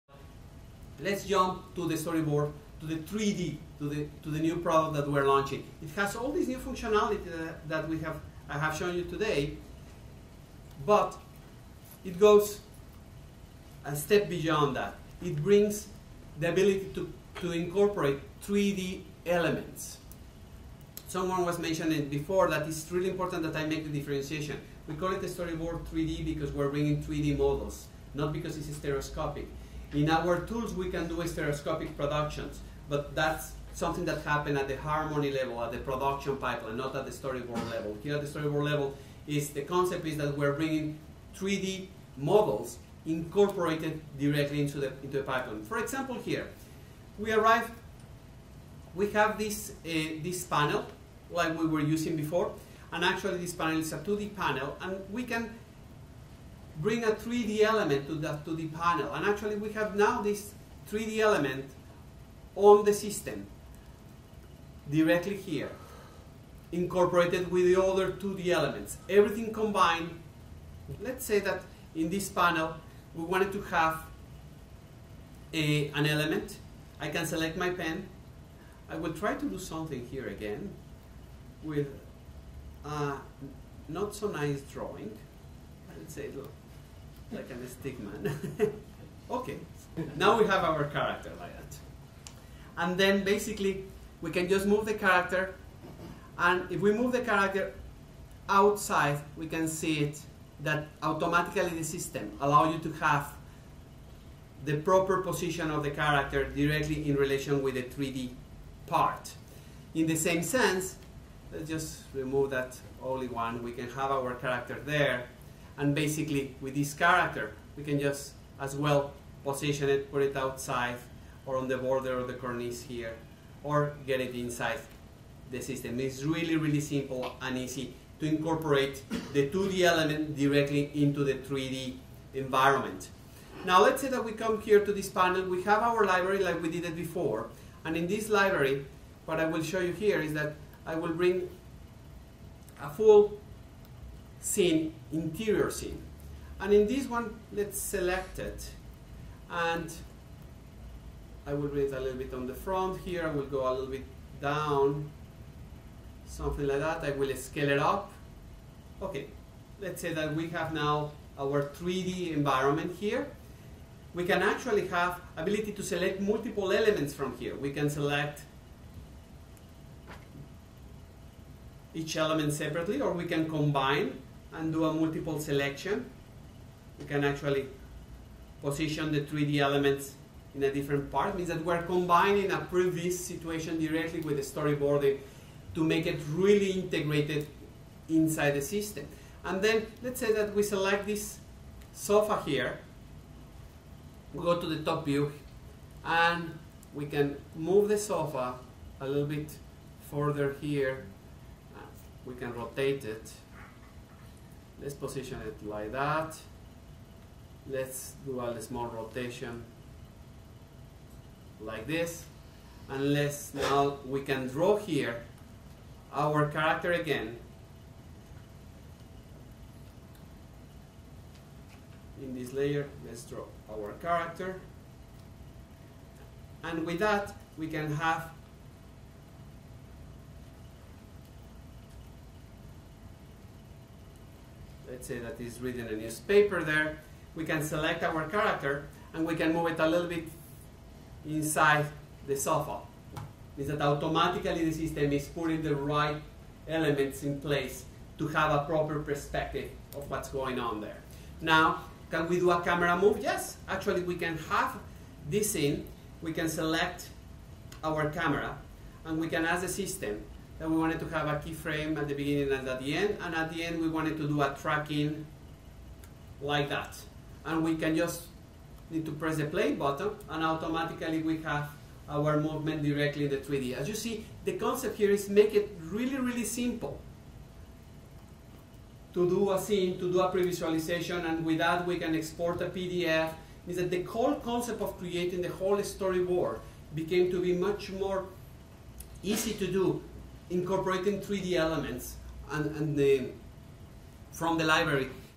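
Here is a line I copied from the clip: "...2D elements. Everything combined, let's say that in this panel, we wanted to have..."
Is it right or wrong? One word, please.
right.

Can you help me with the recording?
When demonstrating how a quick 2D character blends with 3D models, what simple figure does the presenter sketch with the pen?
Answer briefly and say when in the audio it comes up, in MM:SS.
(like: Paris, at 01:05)
Stickman, at 01:27.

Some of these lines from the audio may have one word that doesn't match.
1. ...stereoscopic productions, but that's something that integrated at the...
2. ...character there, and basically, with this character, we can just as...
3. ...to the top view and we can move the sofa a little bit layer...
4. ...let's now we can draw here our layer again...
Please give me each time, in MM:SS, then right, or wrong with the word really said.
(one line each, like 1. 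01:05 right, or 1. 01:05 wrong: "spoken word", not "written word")
1. 00:31 wrong: "happened", not "integrated"
2. 01:54 right
3. 03:14 wrong: "further", not "layer"
4. 03:33 wrong: "character", not "layer".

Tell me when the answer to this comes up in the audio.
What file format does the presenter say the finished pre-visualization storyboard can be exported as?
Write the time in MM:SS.
04:42.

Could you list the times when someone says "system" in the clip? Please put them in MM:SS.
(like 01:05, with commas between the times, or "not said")
01:02, 01:41, 02:05, 03:08, 04:04, 04:19.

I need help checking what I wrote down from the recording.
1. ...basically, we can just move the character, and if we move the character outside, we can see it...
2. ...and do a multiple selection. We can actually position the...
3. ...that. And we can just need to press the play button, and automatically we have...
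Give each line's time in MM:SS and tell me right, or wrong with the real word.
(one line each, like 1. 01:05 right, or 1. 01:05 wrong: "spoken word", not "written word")
1. 01:33 right
2. 02:54 right
3. 04:26 right.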